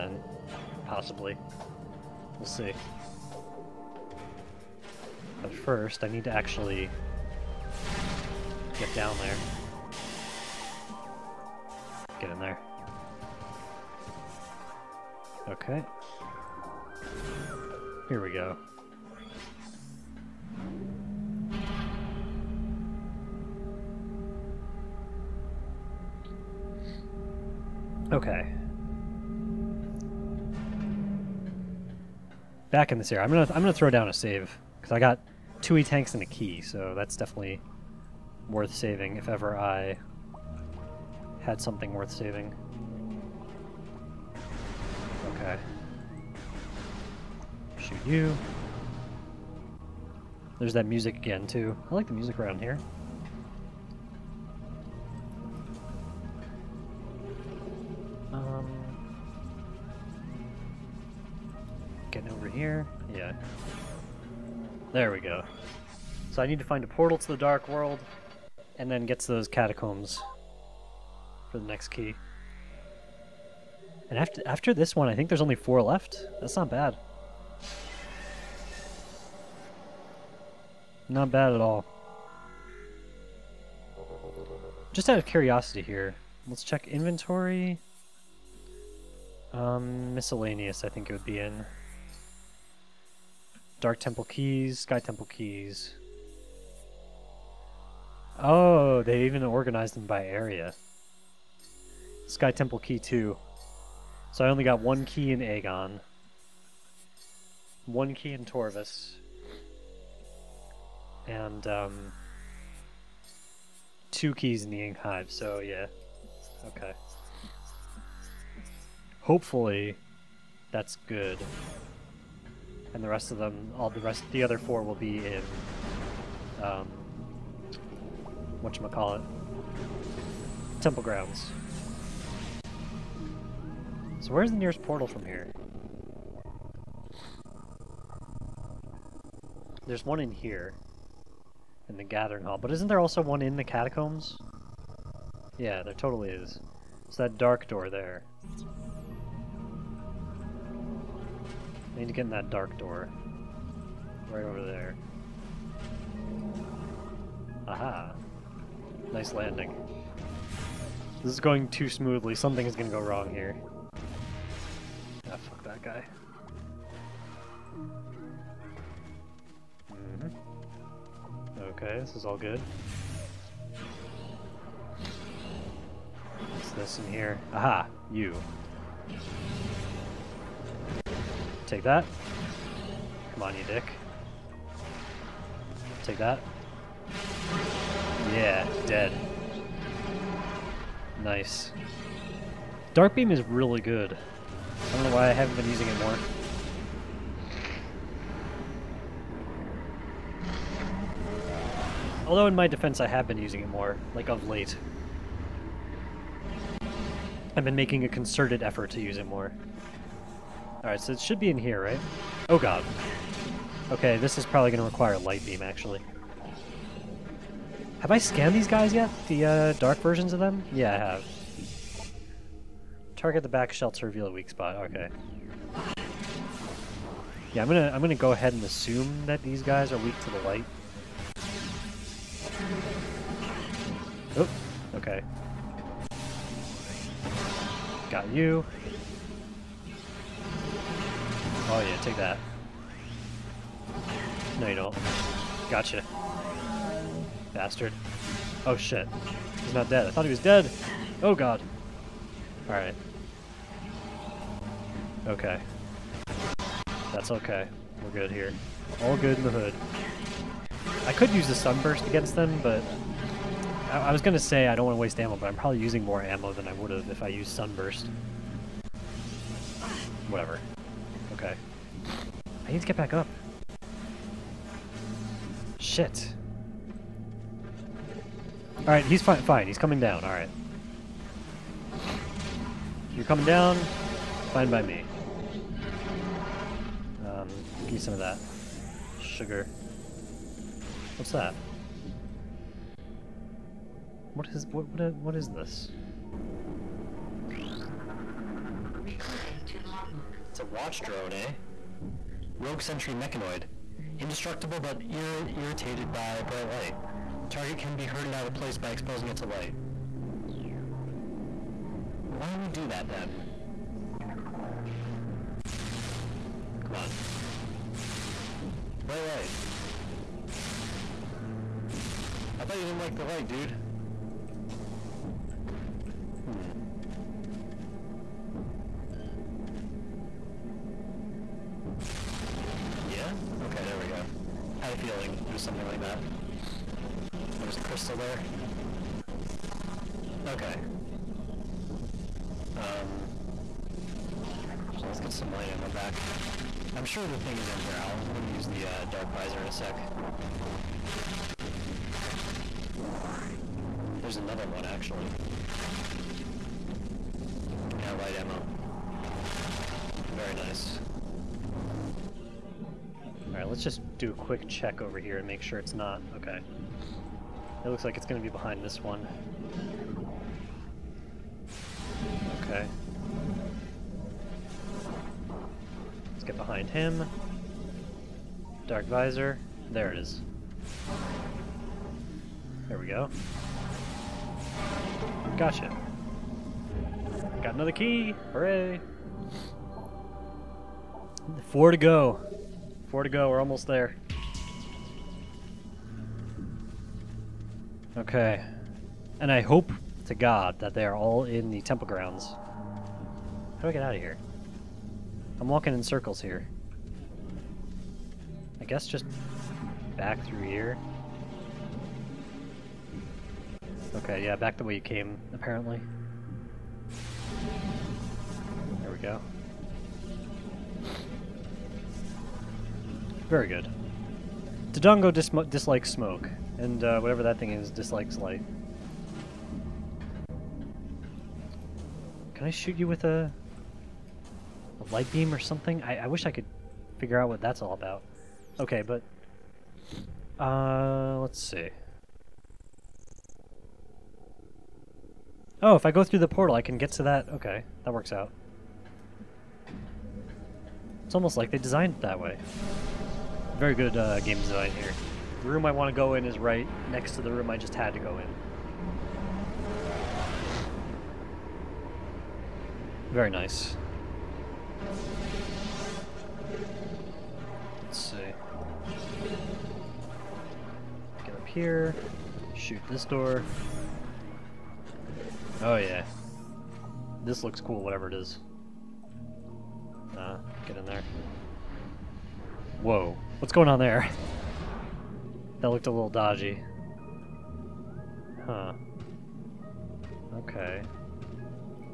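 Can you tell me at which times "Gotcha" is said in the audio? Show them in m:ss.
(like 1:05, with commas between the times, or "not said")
4:05, 6:25.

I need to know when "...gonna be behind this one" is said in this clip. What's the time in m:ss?
6:08.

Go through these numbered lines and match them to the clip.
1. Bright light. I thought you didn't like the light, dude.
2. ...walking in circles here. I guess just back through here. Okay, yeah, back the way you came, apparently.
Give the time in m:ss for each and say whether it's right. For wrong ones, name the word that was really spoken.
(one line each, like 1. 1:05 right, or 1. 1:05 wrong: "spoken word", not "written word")
1. 5:19 right
2. 6:45 right.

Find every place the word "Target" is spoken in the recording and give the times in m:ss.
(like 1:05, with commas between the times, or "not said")
3:43, 5:07.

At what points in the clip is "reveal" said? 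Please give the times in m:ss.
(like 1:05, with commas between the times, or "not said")
3:44.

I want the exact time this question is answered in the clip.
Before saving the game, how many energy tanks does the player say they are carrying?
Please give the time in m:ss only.
0:35.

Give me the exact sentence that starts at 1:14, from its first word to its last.
And after, after this one, I think there's only four left.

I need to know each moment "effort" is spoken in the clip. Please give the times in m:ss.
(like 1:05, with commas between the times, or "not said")
3:28.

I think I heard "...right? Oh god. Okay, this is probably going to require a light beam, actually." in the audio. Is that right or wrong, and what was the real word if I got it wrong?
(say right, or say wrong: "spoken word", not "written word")
right.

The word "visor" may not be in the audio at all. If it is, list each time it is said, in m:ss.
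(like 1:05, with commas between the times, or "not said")
5:49, 6:19.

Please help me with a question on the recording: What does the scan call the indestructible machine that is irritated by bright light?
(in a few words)
Rogue sentry mechanoid.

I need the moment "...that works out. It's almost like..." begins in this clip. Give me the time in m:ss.
7:28.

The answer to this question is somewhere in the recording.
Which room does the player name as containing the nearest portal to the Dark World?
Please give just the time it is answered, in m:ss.
2:22.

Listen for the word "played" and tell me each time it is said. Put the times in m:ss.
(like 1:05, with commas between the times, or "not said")
not said.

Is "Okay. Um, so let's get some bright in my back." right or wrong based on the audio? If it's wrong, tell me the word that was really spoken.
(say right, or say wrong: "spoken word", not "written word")
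wrong: "light", not "bright".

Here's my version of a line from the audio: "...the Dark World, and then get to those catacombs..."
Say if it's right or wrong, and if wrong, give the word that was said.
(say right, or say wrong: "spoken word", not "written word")
right.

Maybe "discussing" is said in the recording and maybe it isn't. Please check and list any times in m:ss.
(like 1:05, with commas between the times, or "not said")
not said.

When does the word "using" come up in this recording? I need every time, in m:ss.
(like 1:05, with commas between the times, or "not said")
3:15, 3:23, 4:25.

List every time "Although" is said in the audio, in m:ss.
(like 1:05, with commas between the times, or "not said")
3:22.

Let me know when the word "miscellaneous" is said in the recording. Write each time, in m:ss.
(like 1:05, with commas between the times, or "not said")
1:30.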